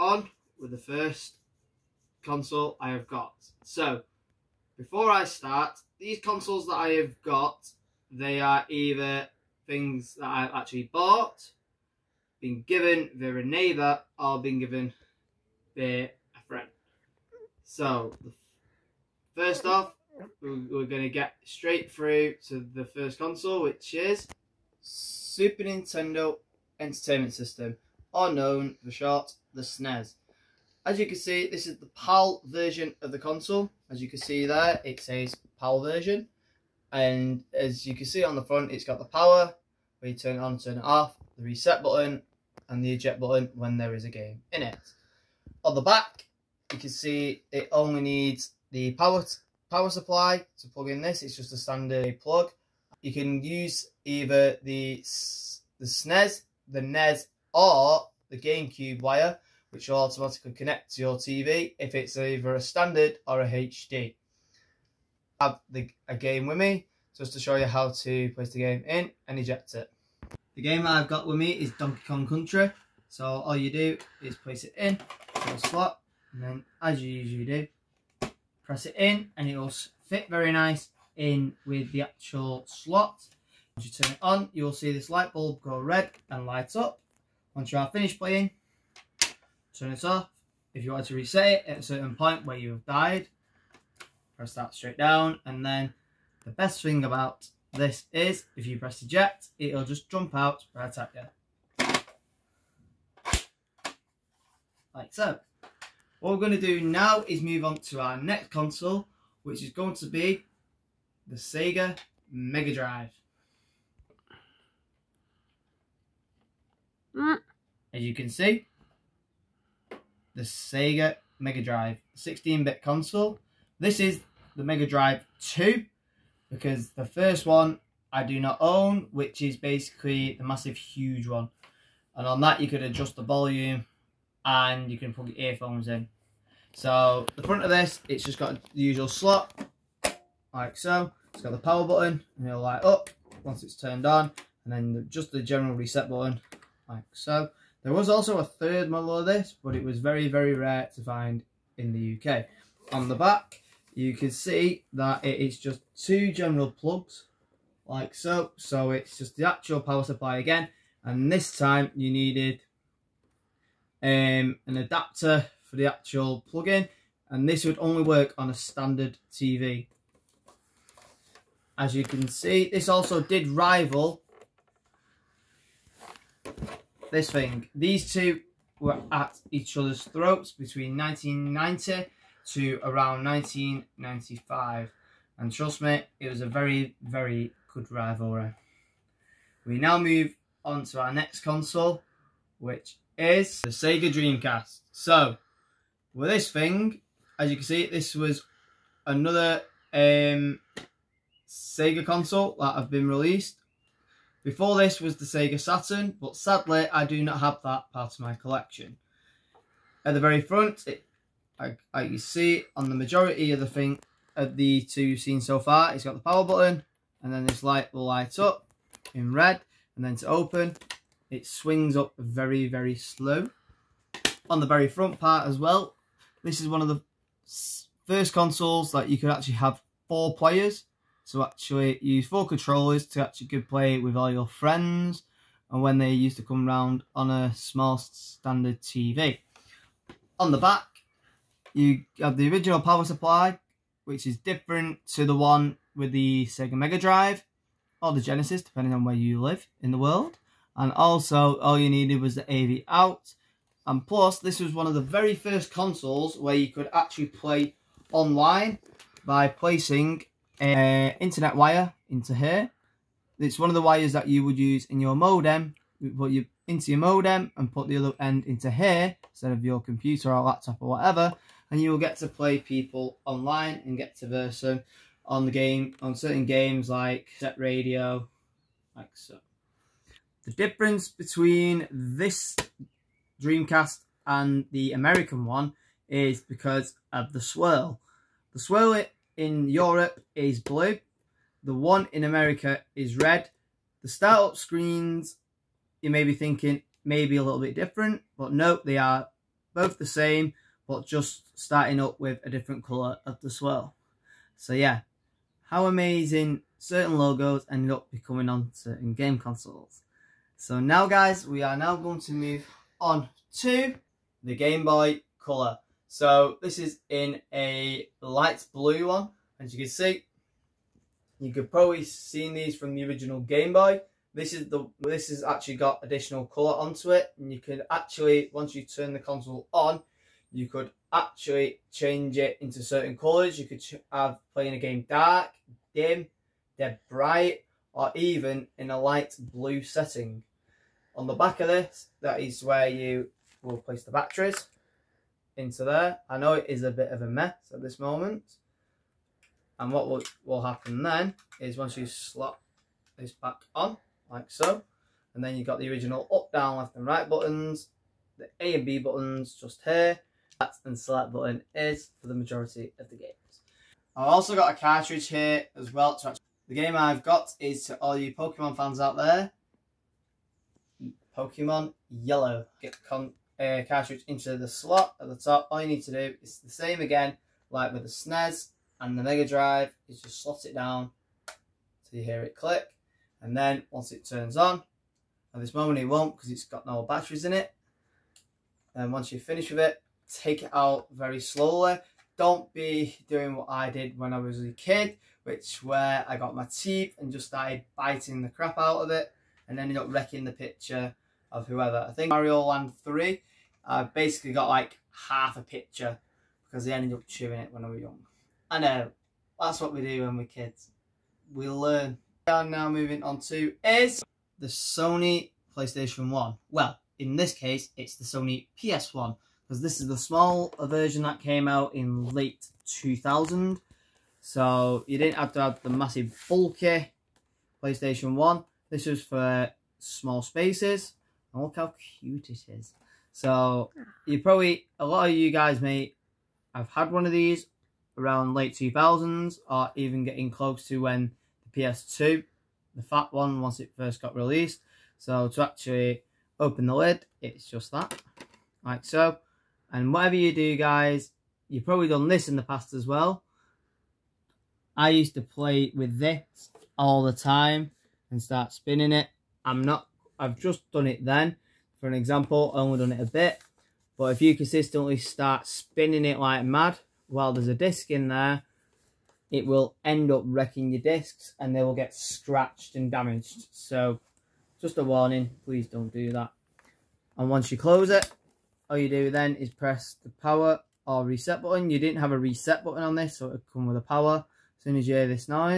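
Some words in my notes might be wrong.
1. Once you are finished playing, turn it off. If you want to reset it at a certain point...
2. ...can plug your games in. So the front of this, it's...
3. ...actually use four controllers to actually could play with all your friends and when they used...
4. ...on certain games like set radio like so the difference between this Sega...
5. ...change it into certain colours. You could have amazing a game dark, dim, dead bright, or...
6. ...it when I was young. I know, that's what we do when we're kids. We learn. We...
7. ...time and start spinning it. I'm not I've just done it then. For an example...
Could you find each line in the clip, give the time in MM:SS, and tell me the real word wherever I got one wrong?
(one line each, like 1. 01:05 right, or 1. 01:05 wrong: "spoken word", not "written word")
1. 01:27 right
2. 02:14 wrong: "earphones", not "games"
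3. 03:51 right
4. 04:36 wrong: "Dreamcast", not "Sega"
5. 05:31 wrong: "playing", not "amazing"
6. 06:47 right
7. 07:37 right.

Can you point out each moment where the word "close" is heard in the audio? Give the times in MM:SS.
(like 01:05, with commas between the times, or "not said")
07:20, 07:57.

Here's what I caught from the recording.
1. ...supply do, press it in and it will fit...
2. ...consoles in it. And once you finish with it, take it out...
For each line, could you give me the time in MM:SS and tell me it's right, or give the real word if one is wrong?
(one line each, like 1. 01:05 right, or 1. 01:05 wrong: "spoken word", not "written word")
1. 01:17 wrong: "usually", not "supply"
2. 06:27 wrong: "batteries", not "consoles".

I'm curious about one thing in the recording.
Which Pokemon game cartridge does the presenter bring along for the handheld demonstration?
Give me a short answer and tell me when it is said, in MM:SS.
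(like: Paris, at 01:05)
Pokemon Yellow, at 06:11.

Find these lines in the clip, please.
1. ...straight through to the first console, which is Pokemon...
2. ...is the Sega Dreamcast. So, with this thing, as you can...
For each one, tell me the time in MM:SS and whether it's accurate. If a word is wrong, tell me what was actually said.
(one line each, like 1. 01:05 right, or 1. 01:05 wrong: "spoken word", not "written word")
1. 00:21 wrong: "Super", not "Pokemon"
2. 03:13 right.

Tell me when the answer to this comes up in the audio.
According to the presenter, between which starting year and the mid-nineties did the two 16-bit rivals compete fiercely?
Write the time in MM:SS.
03:00.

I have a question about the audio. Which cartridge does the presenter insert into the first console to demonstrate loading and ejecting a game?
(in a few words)
Donkey Kong Country.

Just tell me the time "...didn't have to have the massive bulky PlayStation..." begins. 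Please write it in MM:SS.
07:05.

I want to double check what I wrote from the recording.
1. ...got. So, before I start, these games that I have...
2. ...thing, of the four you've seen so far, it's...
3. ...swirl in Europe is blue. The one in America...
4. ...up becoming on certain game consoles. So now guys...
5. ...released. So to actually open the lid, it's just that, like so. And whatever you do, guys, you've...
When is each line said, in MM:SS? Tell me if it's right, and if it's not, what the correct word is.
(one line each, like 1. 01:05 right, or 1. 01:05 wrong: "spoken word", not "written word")
1. 00:03 wrong: "consoles", not "games"
2. 03:33 wrong: "two", not "four"
3. 04:48 right
4. 05:07 right
5. 07:24 right.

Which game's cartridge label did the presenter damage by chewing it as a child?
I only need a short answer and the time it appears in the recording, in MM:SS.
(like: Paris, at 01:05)
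Mario Land 3, at 06:42.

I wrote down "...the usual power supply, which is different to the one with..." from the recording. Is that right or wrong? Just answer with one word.
wrong.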